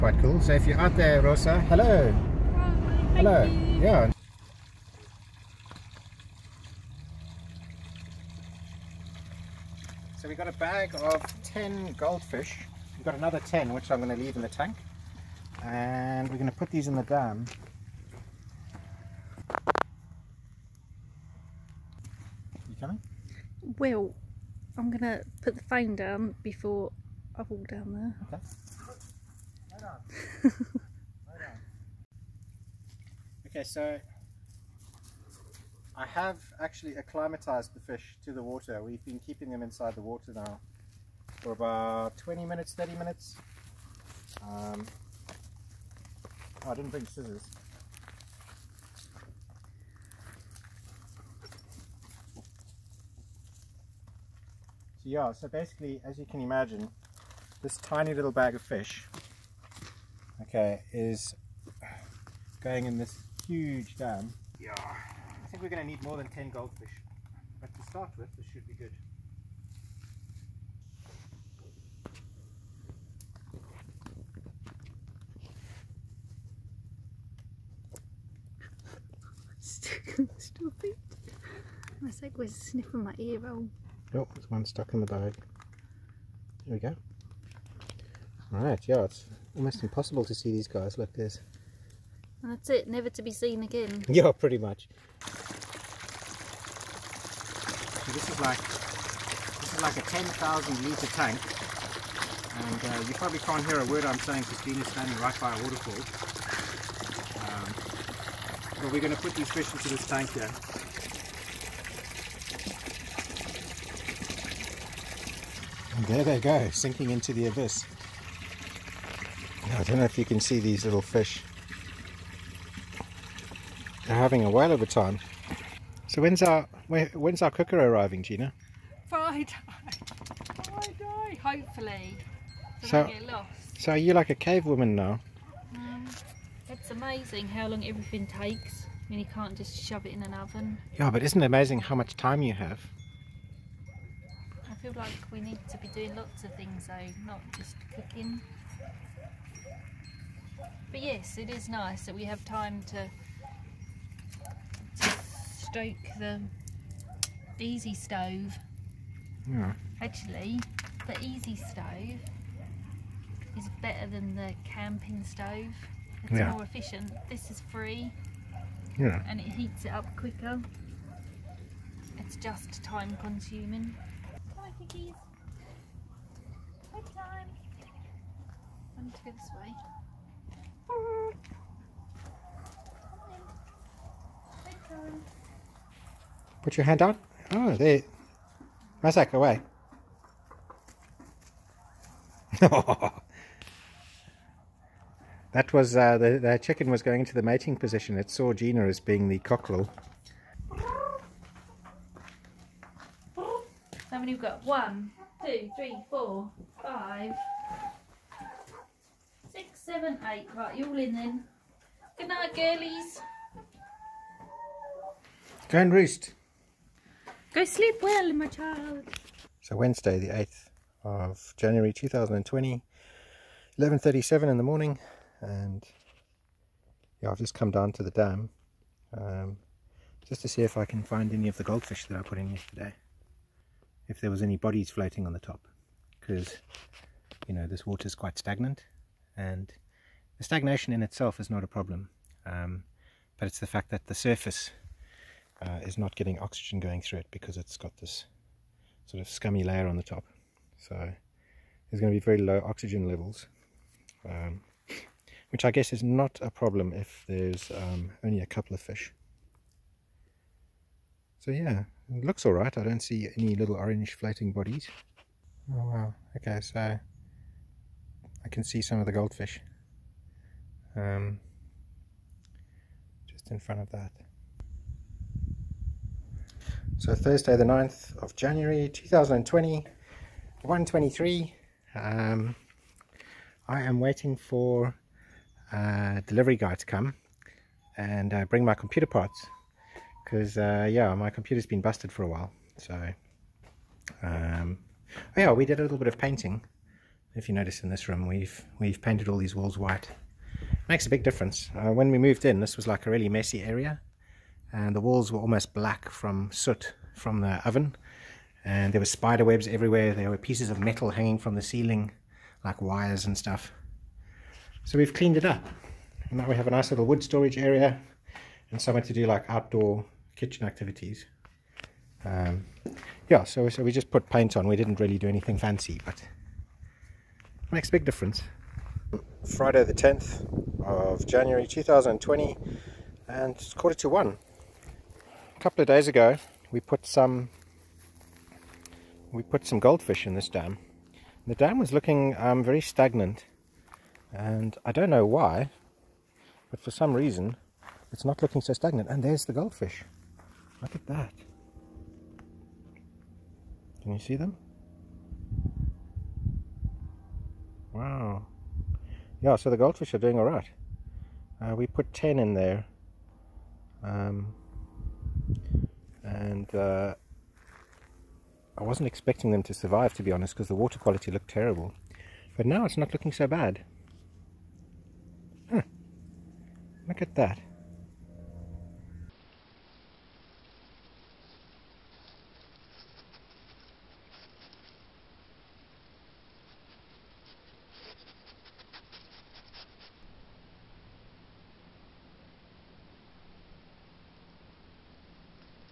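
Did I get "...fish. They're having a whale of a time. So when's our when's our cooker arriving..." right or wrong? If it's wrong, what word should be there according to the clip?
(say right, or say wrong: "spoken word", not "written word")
right.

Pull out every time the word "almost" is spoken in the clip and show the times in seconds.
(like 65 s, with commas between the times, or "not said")
89 s, 305 s.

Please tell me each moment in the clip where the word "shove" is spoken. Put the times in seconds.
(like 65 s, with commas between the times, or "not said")
139 s.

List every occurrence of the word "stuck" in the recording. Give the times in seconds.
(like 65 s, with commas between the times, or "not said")
84 s.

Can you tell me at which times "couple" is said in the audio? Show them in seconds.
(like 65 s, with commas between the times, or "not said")
258 s, 335 s.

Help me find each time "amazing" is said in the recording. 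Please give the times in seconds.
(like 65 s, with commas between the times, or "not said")
137 s, 141 s.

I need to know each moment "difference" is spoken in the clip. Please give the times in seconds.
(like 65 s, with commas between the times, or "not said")
301 s, 328 s.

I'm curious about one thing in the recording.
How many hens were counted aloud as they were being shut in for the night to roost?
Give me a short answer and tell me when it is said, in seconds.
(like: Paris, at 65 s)
8, at 210 s.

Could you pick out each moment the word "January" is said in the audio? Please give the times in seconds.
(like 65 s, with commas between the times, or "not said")
221 s, 278 s, 331 s.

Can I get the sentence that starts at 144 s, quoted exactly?
I feel like we need to be doing lots of things though, not just cooking.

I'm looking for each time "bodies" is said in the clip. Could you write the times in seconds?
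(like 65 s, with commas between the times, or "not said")
234 s, 264 s.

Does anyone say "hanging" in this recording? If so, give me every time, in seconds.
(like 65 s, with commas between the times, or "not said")
311 s.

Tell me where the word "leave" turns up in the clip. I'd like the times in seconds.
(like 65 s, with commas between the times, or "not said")
14 s.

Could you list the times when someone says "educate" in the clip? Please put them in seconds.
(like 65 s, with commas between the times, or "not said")
not said.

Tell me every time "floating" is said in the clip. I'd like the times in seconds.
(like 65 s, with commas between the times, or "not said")
234 s, 264 s.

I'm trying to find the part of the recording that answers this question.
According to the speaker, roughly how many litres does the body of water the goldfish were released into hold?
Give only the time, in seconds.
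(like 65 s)
100 s.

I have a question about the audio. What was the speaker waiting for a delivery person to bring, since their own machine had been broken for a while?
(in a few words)
computer parts.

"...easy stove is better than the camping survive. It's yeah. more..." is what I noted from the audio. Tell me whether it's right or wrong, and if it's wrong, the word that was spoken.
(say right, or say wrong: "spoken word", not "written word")
wrong: "stove", not "survive".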